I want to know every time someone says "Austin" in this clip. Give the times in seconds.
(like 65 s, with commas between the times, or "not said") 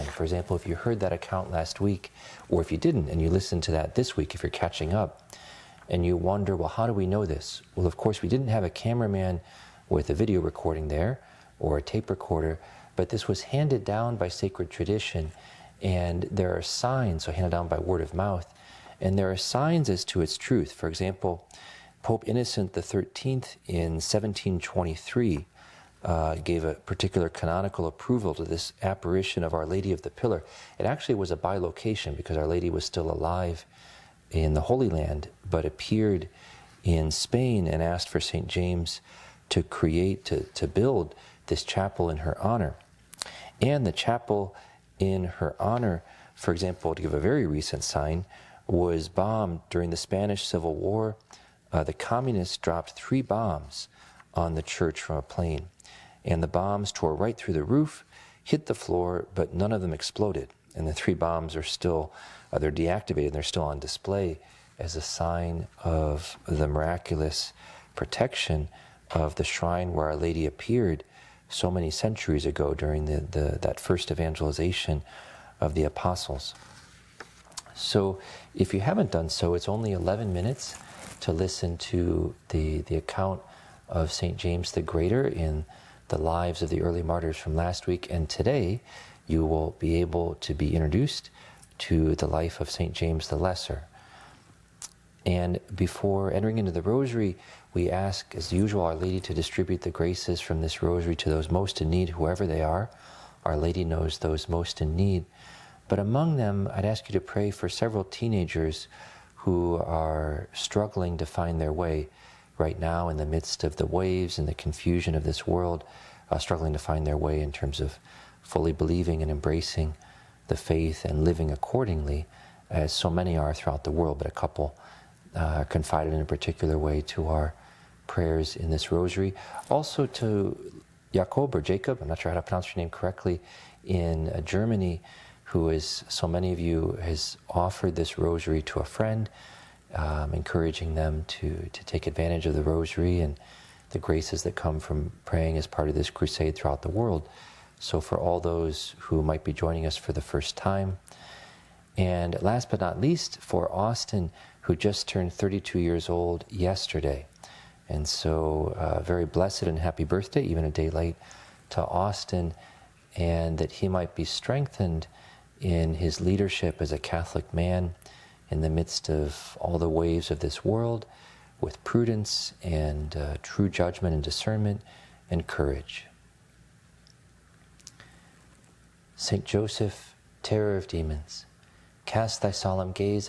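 153 s, 161 s.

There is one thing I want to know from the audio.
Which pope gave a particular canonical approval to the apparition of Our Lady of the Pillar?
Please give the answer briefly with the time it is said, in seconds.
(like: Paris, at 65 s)
Pope Innocent XIII, at 22 s.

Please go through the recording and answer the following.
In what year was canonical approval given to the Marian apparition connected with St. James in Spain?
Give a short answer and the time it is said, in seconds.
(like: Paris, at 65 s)
1723, at 23 s.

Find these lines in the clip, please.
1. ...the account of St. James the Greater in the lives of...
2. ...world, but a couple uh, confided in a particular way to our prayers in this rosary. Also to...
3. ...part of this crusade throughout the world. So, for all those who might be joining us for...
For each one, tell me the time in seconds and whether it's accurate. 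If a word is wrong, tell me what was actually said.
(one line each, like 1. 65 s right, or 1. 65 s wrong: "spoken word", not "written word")
1. 82 s right
2. 123 s right
3. 145 s right.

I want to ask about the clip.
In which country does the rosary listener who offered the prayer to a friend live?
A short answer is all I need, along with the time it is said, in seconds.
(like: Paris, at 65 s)
Germany, at 134 s.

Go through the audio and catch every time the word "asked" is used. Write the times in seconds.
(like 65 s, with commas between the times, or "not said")
37 s.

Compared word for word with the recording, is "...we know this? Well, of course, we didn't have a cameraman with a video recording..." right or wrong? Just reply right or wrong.
right.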